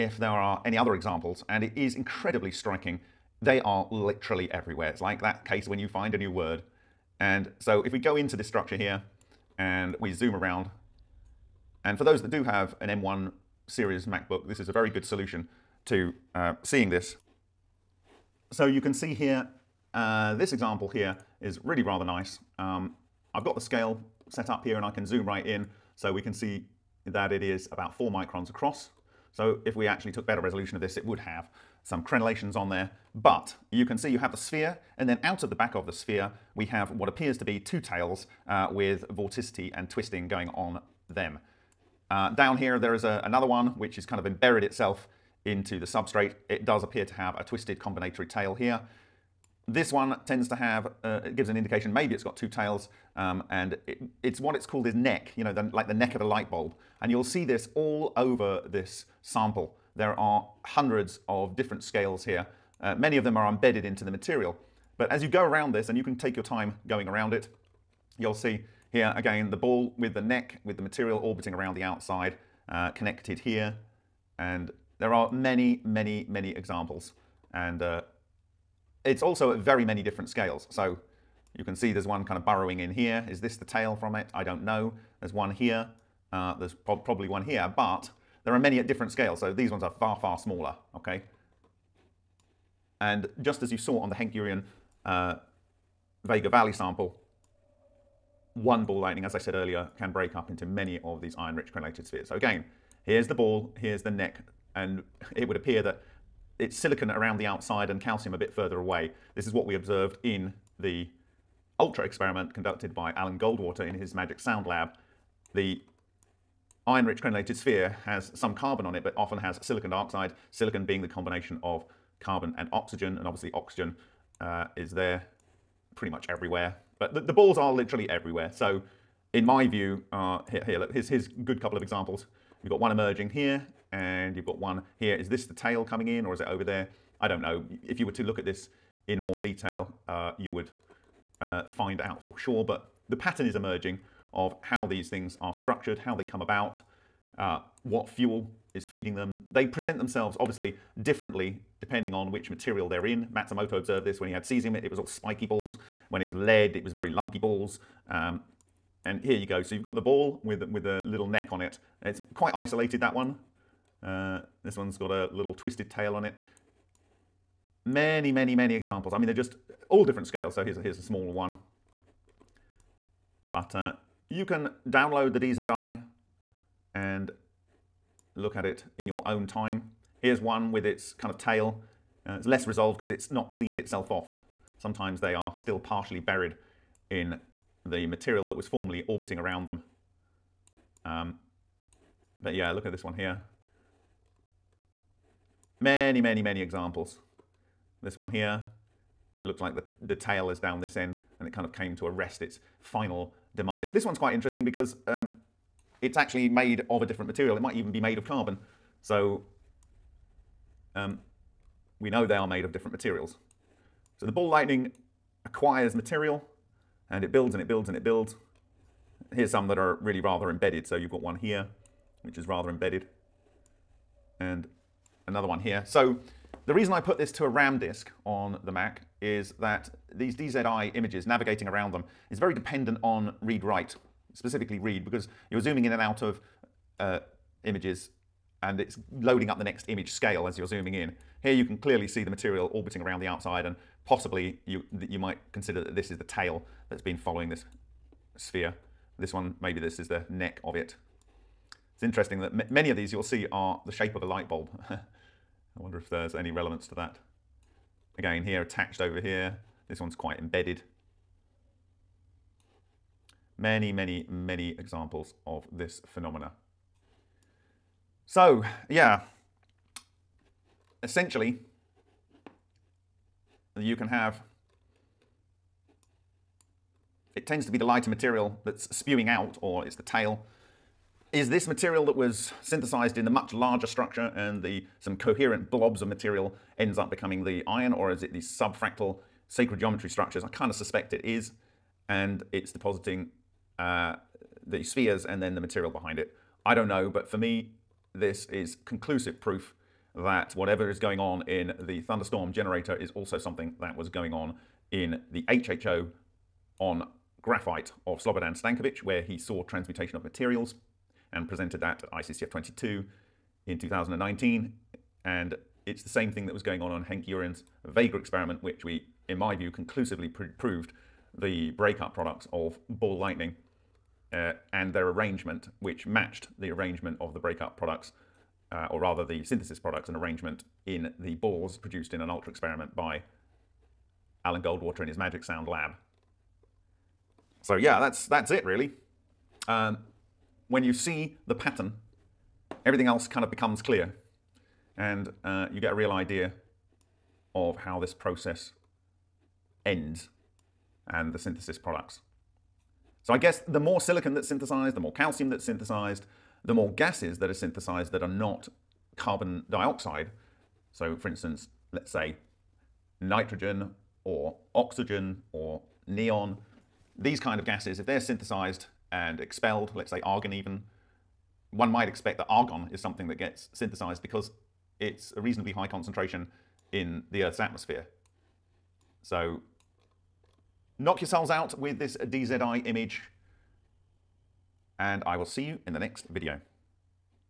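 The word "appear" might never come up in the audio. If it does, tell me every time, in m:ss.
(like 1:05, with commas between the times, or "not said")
0:37, 0:46, 1:45.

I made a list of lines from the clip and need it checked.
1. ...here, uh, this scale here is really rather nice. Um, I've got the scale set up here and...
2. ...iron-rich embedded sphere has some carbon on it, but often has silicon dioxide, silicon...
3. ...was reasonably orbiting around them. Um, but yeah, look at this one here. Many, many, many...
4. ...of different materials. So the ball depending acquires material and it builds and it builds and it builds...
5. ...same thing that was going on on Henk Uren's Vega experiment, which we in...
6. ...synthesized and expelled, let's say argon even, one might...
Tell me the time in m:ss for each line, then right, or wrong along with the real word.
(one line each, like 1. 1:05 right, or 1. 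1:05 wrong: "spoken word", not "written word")
1. 0:19 wrong: "example", not "scale"
2. 1:56 wrong: "crenellated", not "embedded"
3. 3:08 wrong: "formerly", not "reasonably"
4. 3:32 wrong: "lightning", not "depending"
5. 5:16 right
6. 6:08 right.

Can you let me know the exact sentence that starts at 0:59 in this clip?
There are hundreds of different scales here.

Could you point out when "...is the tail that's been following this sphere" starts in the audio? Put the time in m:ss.
4:06.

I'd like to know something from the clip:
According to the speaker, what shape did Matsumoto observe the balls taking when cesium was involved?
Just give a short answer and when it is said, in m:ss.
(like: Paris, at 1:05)
spiky balls, at 2:35.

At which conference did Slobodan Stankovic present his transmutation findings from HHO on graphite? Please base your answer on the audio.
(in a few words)
ICCF 22.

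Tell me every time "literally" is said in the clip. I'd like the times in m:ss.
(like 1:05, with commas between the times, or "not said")
0:03, 2:07.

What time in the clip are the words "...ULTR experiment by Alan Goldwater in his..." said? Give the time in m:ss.
5:32.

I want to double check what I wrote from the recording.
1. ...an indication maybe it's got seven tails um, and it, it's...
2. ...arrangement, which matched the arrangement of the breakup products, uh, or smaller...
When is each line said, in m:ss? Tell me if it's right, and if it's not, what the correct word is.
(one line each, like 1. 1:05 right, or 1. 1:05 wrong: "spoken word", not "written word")
1. 0:51 wrong: "two", not "seven"
2. 5:25 wrong: "rather", not "smaller".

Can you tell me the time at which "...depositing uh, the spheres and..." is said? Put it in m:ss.
4:52.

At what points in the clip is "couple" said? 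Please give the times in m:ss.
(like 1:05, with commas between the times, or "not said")
2:11.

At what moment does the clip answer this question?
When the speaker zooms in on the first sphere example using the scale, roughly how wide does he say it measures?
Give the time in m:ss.
0:27.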